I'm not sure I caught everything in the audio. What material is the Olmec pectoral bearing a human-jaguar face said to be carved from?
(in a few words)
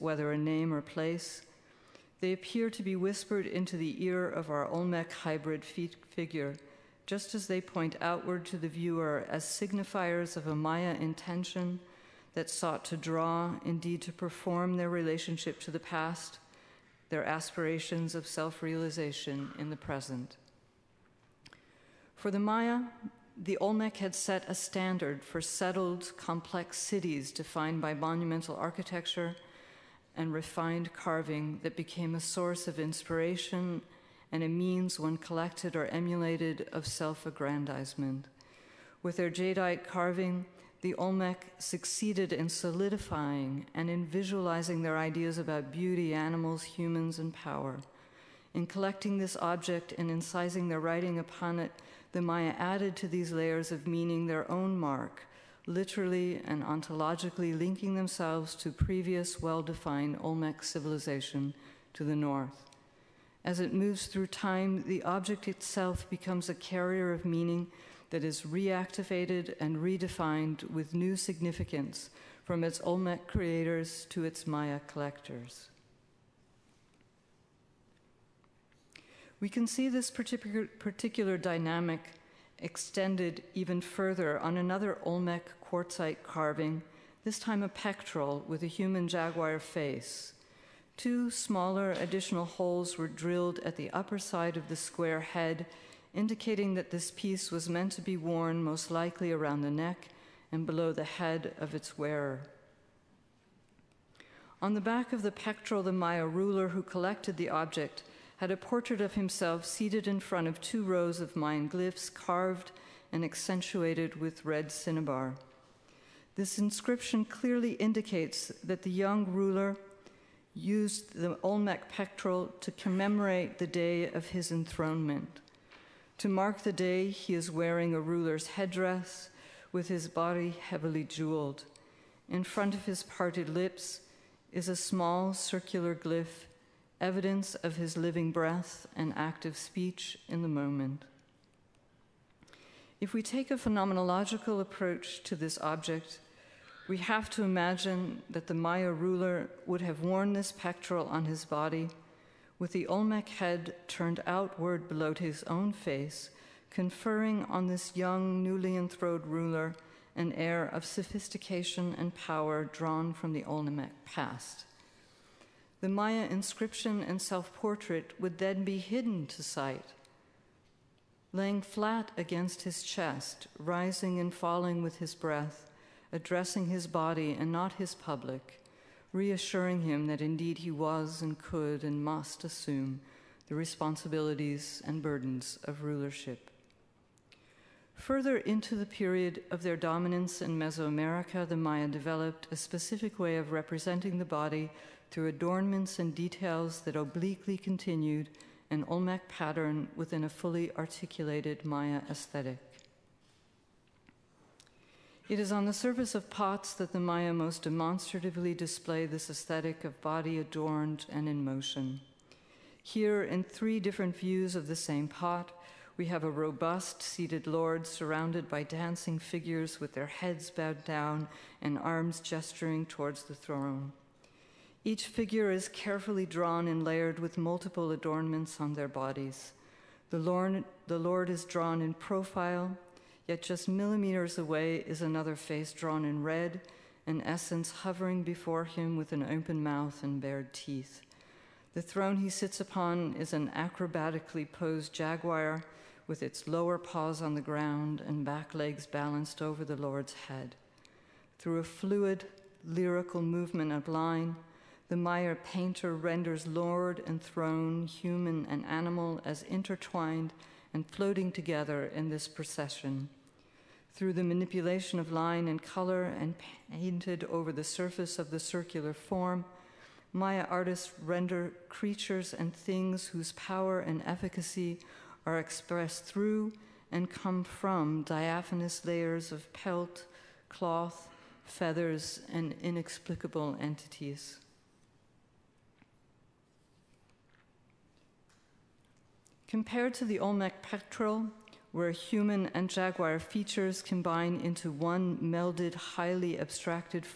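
Quartzite.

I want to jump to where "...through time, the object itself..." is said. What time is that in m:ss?
1:04.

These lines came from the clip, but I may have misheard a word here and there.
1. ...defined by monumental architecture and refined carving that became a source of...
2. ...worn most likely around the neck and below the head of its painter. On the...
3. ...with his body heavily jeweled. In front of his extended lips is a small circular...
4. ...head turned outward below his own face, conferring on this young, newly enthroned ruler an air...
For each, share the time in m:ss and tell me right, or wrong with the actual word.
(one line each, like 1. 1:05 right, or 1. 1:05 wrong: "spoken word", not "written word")
1. 0:27 right
2. 1:38 wrong: "wearer", not "painter"
3. 2:09 wrong: "parted", not "extended"
4. 2:33 right.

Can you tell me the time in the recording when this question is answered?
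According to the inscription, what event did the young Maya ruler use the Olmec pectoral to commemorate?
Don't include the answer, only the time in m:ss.
2:04.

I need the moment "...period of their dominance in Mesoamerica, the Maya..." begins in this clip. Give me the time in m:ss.
3:08.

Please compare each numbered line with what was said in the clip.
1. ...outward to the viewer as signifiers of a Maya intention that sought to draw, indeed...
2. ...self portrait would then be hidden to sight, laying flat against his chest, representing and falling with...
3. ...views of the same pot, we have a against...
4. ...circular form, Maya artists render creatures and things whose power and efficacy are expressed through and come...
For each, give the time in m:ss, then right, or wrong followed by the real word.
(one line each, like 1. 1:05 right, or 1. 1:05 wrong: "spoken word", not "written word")
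1. 0:08 right
2. 2:47 wrong: "rising", not "representing"
3. 3:34 wrong: "robust", not "against"
4. 4:28 right.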